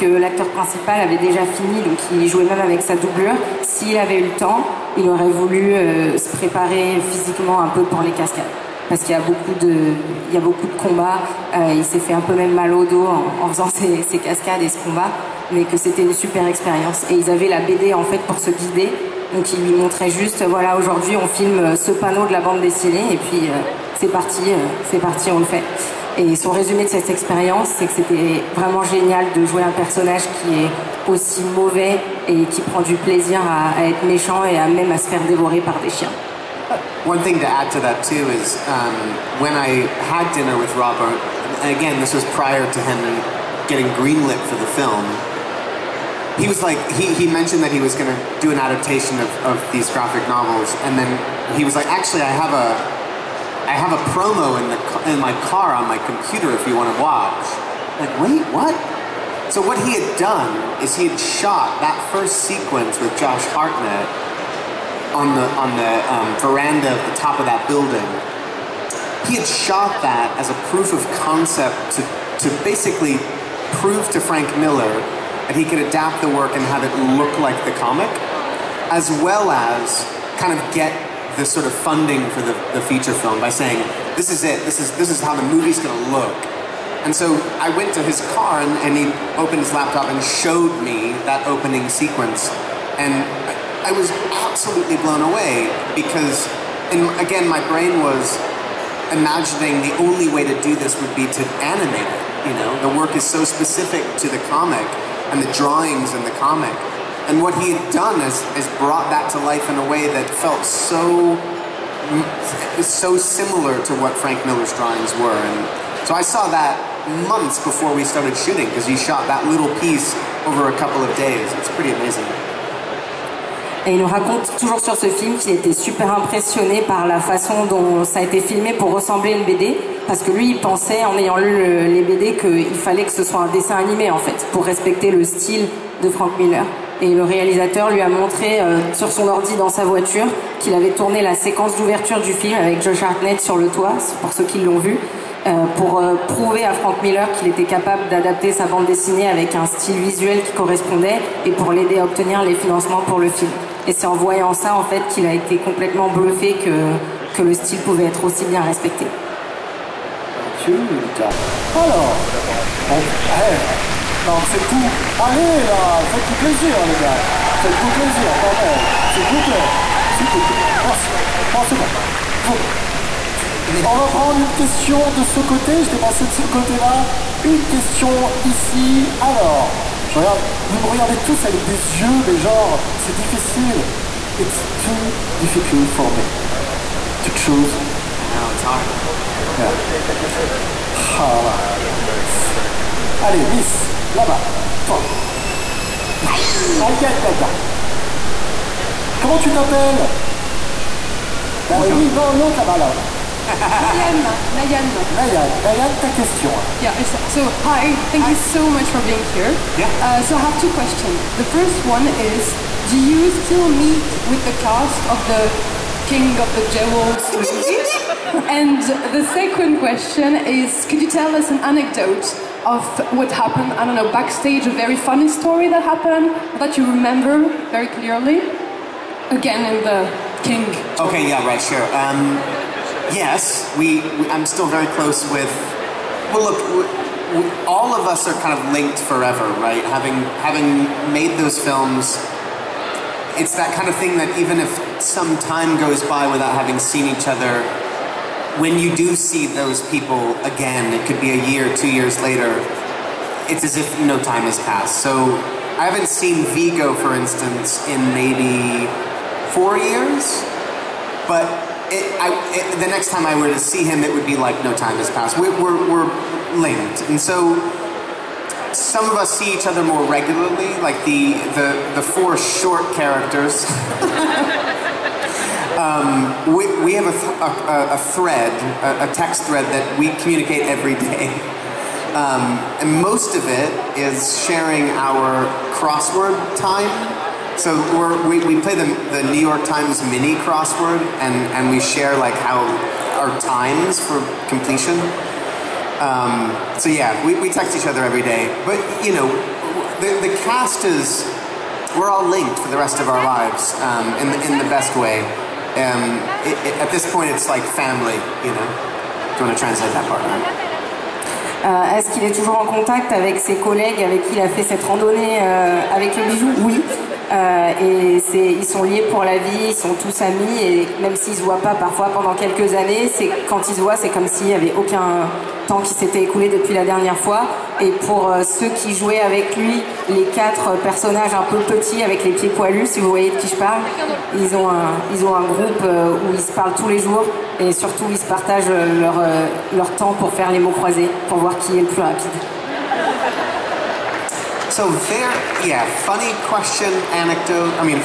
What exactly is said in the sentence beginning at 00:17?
Et ils avaient la BD en fait pour se guider.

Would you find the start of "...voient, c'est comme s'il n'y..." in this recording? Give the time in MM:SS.
05:23.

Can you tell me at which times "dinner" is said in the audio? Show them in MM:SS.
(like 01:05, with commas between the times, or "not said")
00:40.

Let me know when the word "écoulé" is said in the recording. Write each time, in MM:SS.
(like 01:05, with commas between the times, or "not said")
05:26.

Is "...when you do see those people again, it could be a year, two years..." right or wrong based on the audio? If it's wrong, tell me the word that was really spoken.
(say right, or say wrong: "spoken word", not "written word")
right.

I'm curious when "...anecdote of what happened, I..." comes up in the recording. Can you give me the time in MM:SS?
03:41.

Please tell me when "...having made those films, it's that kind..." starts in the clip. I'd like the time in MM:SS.
04:00.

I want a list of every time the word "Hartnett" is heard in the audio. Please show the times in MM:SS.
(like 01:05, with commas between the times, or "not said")
01:03, 02:23.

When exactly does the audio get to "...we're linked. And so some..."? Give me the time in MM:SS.
04:25.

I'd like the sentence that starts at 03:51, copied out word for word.
Um, yes, we, we, I'm still very close with.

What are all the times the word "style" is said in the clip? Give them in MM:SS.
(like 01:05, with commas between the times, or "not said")
02:15, 02:29, 02:37.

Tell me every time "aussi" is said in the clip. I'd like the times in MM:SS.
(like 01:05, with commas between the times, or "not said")
00:31, 02:38.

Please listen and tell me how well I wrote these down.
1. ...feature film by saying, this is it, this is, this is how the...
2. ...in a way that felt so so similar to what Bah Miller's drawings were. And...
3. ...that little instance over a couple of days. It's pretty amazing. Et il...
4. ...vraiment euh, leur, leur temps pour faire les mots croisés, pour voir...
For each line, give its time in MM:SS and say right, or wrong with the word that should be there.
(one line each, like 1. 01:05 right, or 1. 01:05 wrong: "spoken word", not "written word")
1. 01:22 right
2. 01:49 wrong: "Frank", not "Bah"
3. 01:59 wrong: "piece", not "instance"
4. 05:38 wrong: "partagent", not "vraiment".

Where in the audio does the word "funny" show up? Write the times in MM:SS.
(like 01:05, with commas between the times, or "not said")
03:44, 05:46.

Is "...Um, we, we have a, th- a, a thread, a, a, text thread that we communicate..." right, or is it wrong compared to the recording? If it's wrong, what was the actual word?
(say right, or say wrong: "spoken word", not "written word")
right.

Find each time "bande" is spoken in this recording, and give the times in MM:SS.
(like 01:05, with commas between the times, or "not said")
00:22, 02:28.